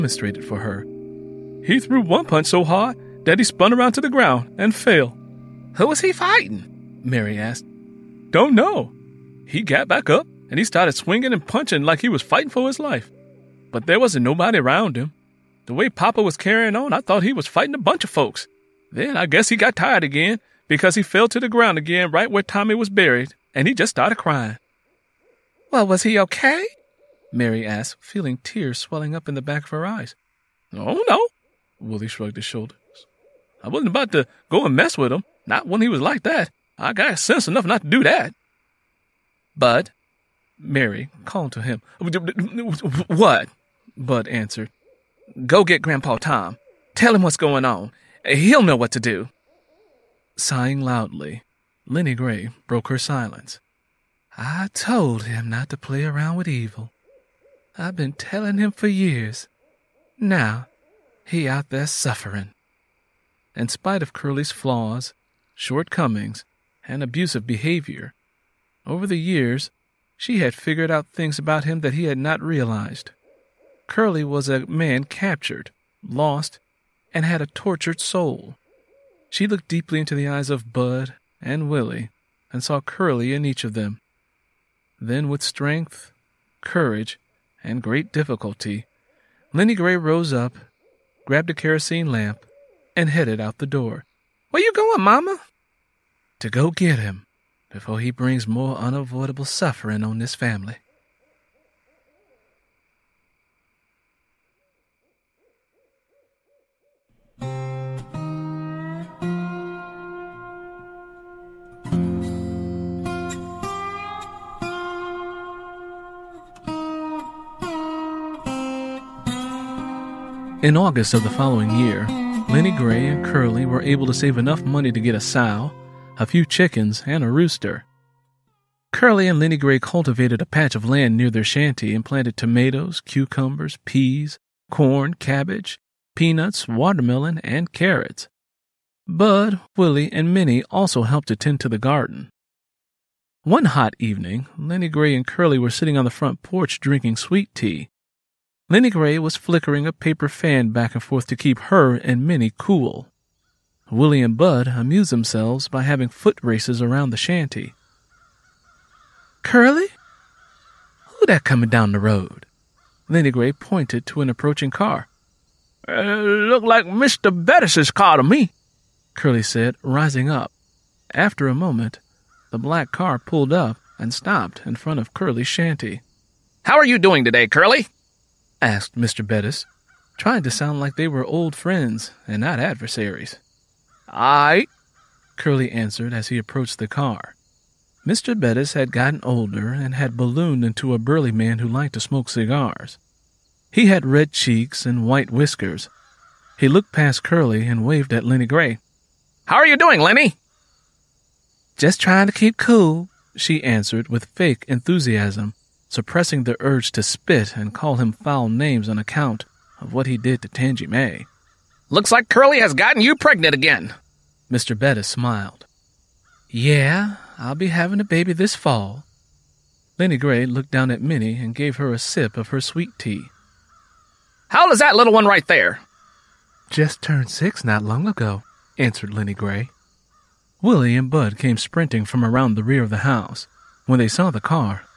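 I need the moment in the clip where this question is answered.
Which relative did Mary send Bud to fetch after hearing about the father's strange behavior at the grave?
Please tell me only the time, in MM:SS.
00:45.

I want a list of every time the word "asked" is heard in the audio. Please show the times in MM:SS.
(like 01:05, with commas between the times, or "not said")
00:07, 00:27, 02:58.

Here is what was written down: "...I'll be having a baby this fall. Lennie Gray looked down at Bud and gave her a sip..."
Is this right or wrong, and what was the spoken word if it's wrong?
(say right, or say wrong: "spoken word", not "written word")
wrong: "Minnie", not "Bud".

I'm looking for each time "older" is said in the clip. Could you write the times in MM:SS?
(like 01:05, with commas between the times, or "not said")
03:09.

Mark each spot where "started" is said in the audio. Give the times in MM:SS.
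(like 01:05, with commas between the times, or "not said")
00:10, 00:23.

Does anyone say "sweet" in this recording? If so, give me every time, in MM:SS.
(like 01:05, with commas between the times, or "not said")
02:27, 03:42.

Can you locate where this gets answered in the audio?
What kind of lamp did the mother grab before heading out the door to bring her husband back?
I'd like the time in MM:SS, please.
01:31.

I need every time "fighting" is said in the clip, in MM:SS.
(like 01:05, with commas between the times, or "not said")
00:06, 00:12, 00:17.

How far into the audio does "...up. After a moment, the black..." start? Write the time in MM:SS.
02:50.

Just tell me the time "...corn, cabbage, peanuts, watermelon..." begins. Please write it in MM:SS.
02:14.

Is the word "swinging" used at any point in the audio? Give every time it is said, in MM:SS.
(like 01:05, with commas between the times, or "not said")
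00:10.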